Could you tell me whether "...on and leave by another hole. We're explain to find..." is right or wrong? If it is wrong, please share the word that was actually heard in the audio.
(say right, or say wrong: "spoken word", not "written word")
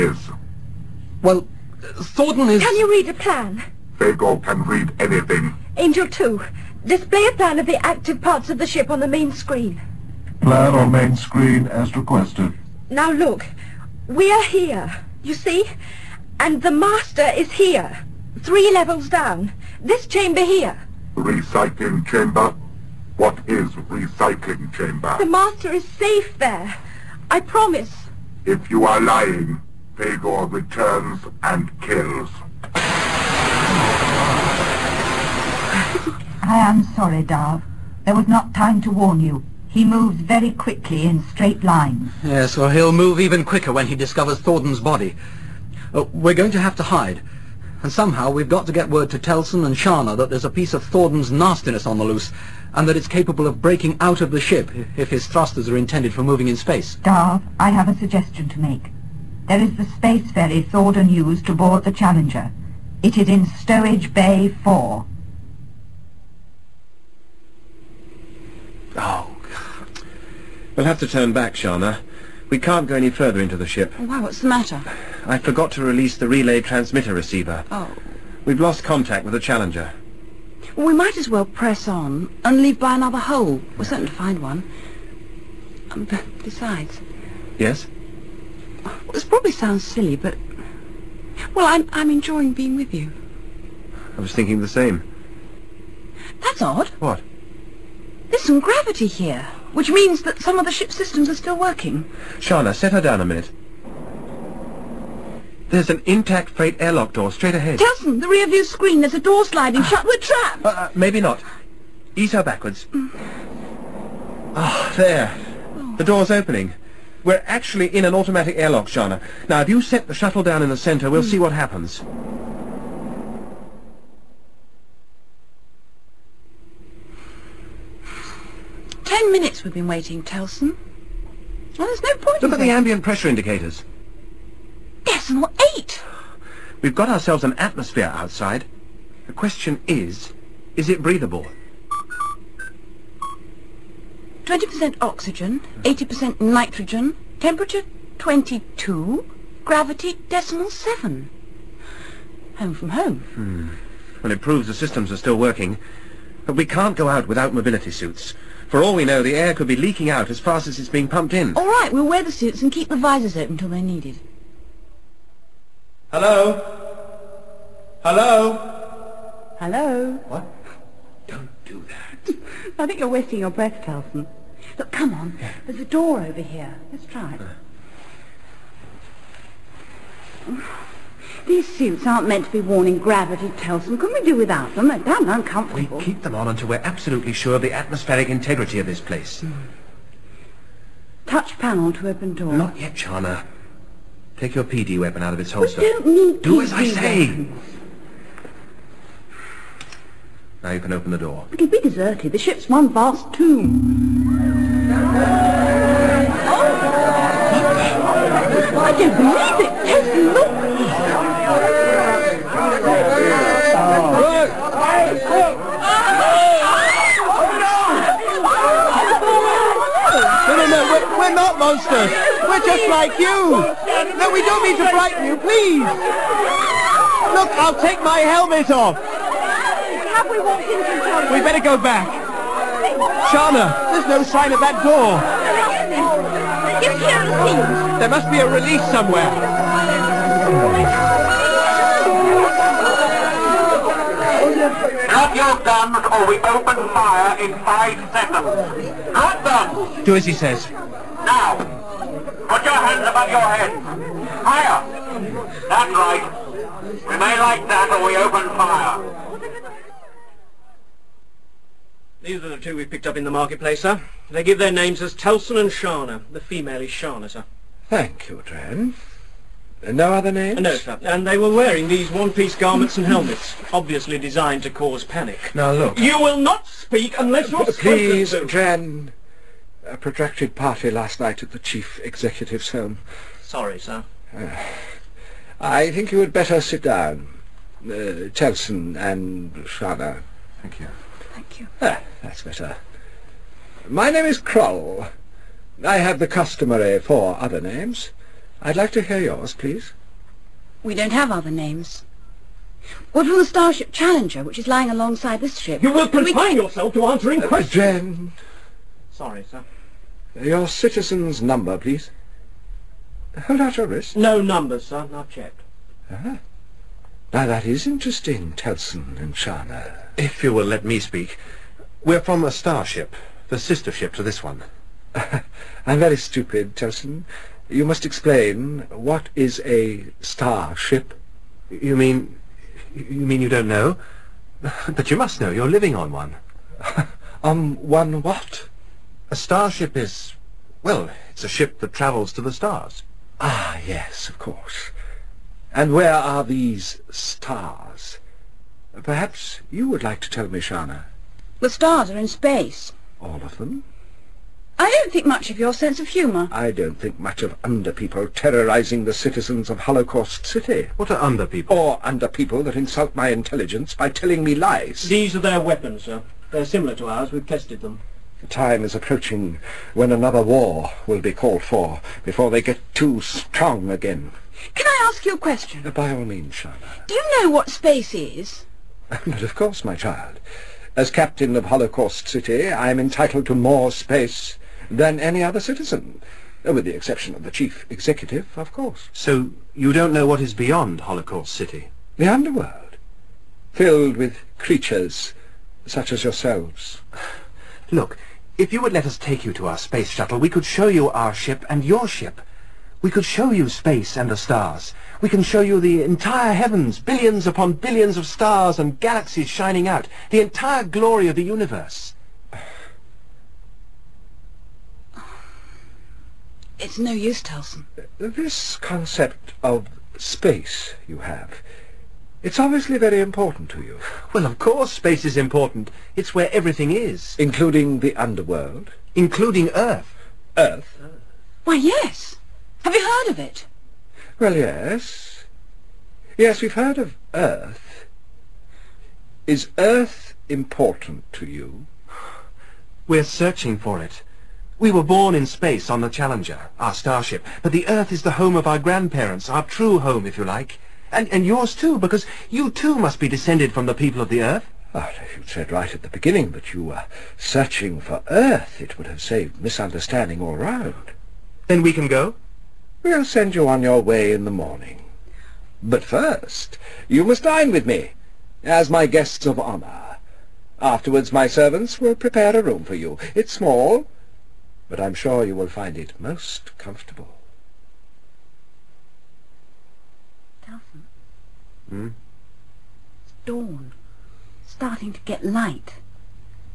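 wrong: "certain", not "explain".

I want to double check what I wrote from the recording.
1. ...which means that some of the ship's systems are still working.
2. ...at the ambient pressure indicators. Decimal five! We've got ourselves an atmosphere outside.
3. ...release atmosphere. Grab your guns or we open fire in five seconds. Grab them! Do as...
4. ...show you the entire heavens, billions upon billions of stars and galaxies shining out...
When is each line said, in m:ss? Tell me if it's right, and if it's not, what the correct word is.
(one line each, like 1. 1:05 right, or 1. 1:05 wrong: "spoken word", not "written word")
1. 1:39 right
2. 2:12 wrong: "eight", not "five"
3. 3:58 wrong: "somewhere", not "atmosphere"
4. 6:45 right.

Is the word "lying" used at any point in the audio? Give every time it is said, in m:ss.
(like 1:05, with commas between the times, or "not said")
0:28, 5:04.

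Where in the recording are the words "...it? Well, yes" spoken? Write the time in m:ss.
7:13.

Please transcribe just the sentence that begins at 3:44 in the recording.
No, we don't mean to frighten you, please.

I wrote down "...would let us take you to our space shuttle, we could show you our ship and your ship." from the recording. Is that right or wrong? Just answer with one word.
right.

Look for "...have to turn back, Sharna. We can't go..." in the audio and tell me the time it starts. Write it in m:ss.
1:10.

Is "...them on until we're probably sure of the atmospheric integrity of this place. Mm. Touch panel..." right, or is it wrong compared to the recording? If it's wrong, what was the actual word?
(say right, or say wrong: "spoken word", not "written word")
wrong: "absolutely", not "probably".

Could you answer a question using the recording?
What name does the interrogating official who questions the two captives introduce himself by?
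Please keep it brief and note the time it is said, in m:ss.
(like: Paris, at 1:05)
Kroll, at 4:54.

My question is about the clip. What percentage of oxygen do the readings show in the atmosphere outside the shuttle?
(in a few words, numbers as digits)
20%.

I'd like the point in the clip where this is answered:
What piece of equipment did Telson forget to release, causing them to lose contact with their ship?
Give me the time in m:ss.
1:16.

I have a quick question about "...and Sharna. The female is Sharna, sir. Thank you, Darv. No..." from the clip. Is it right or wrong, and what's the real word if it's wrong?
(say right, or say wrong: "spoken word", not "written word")
wrong: "Dren", not "Darv".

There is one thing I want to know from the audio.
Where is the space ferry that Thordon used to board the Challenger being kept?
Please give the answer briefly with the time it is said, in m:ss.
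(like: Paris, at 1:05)
Stowage Bay 4, at 1:03.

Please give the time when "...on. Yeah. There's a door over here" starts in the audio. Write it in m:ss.
2:55.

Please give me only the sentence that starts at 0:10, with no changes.
Plan on main screen as requested.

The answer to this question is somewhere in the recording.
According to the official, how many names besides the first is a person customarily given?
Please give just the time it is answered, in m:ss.
4:56.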